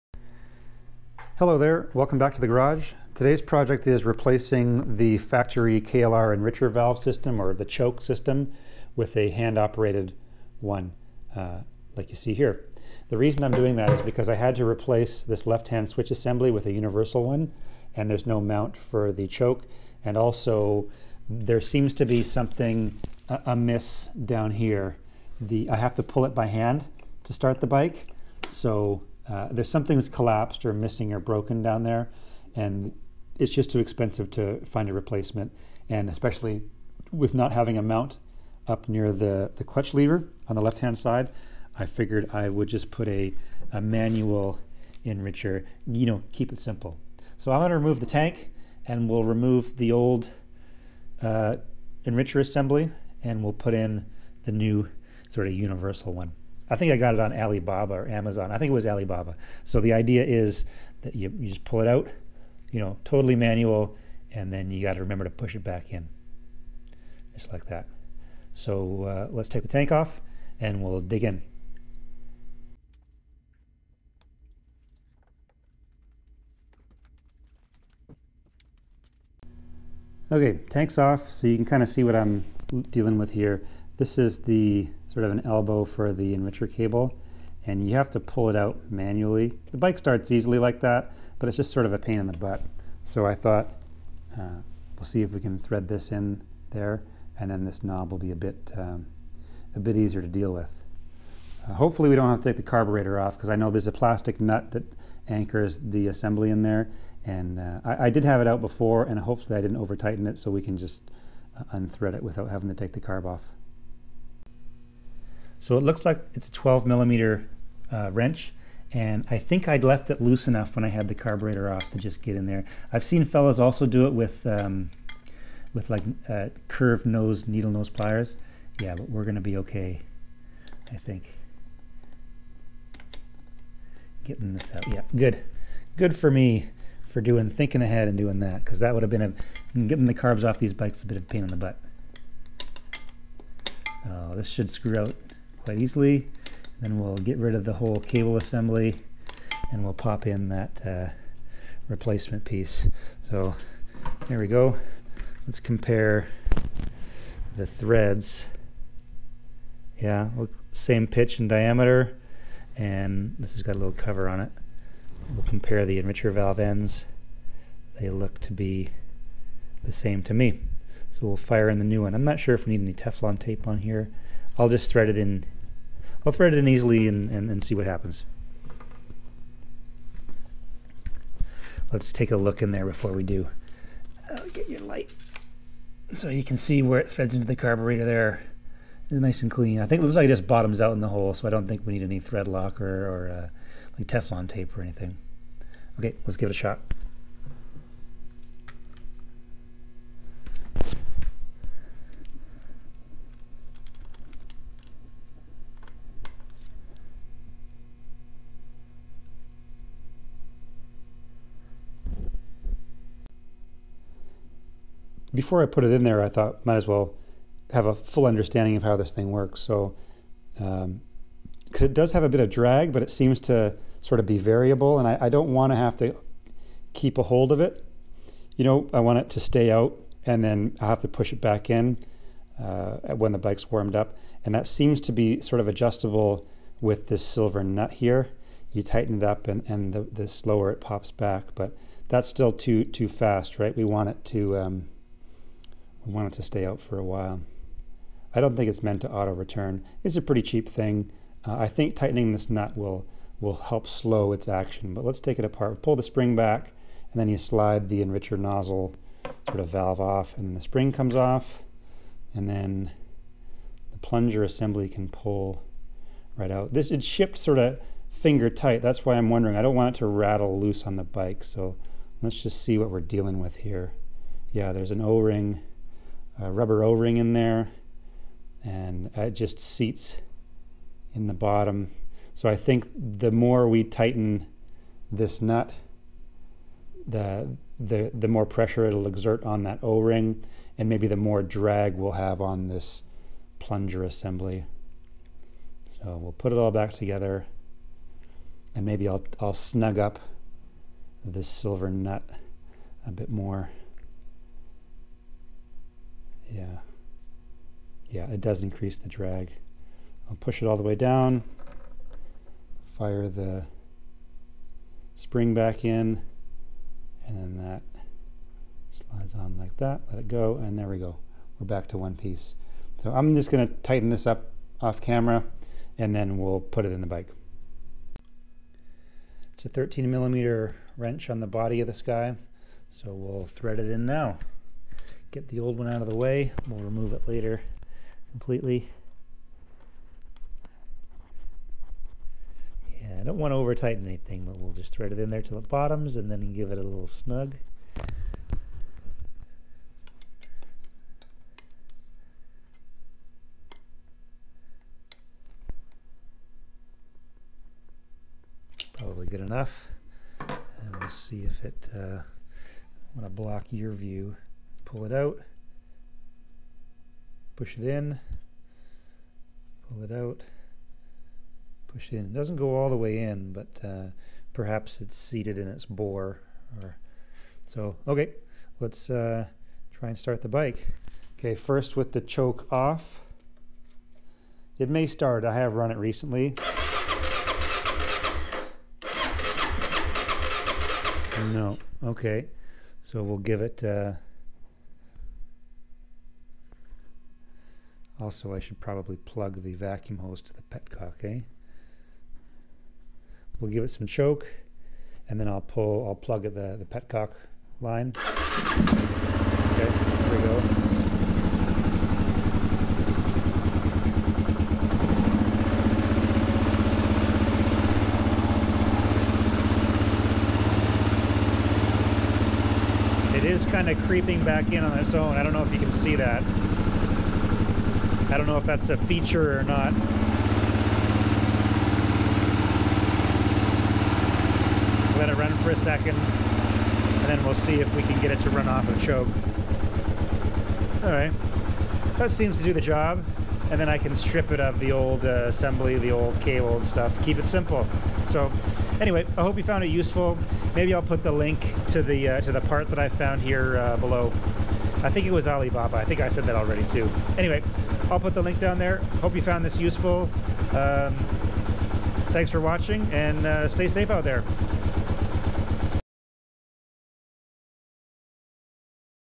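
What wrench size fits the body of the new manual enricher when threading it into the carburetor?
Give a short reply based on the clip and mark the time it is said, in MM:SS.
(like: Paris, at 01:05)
13 mm, at 05:29.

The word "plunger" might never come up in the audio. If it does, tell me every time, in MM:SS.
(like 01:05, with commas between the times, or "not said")
04:23, 04:53.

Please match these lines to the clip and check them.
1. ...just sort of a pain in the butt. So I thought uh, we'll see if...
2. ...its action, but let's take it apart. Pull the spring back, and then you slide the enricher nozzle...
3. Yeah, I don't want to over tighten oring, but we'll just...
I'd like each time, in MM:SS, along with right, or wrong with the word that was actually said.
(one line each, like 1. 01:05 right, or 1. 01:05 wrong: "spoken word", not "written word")
1. 01:31 right
2. 04:14 right
3. 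05:43 wrong: "anything", not "oring".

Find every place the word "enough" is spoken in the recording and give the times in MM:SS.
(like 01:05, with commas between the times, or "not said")
02:00, 05:59.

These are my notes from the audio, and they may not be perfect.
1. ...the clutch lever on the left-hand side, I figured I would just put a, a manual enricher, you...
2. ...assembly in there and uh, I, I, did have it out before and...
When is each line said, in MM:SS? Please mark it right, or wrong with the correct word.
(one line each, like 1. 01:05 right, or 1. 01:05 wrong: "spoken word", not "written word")
1. 00:39 right
2. 01:46 right.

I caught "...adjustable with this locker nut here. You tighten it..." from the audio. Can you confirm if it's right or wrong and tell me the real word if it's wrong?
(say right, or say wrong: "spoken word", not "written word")
wrong: "silver", not "locker".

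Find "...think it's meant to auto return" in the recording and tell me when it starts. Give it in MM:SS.
04:08.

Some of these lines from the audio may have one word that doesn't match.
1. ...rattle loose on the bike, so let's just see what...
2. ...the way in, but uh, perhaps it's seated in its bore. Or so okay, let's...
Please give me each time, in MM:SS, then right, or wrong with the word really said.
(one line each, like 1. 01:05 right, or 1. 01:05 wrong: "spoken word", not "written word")
1. 04:30 right
2. 06:12 right.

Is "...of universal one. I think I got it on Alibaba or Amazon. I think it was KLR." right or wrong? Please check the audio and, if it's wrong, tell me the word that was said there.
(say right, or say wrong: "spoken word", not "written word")
wrong: "Alibaba", not "KLR".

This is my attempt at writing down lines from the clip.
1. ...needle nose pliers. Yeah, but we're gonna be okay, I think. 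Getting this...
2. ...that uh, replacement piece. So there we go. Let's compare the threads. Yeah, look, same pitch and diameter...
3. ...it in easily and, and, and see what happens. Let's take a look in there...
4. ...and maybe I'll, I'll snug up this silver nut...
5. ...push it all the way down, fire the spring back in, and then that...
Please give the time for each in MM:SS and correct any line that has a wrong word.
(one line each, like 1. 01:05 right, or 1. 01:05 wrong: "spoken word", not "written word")
1. 02:07 right
2. 02:30 right
3. 02:56 right
4. 04:58 right
5. 05:10 right.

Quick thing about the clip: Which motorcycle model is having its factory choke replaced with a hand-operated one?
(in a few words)
KLR.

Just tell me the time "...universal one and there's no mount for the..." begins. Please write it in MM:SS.
00:16.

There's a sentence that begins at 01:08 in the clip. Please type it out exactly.
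So uh, let's take the tank off and we'll dig in.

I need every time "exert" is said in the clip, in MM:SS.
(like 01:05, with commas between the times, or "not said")
04:49.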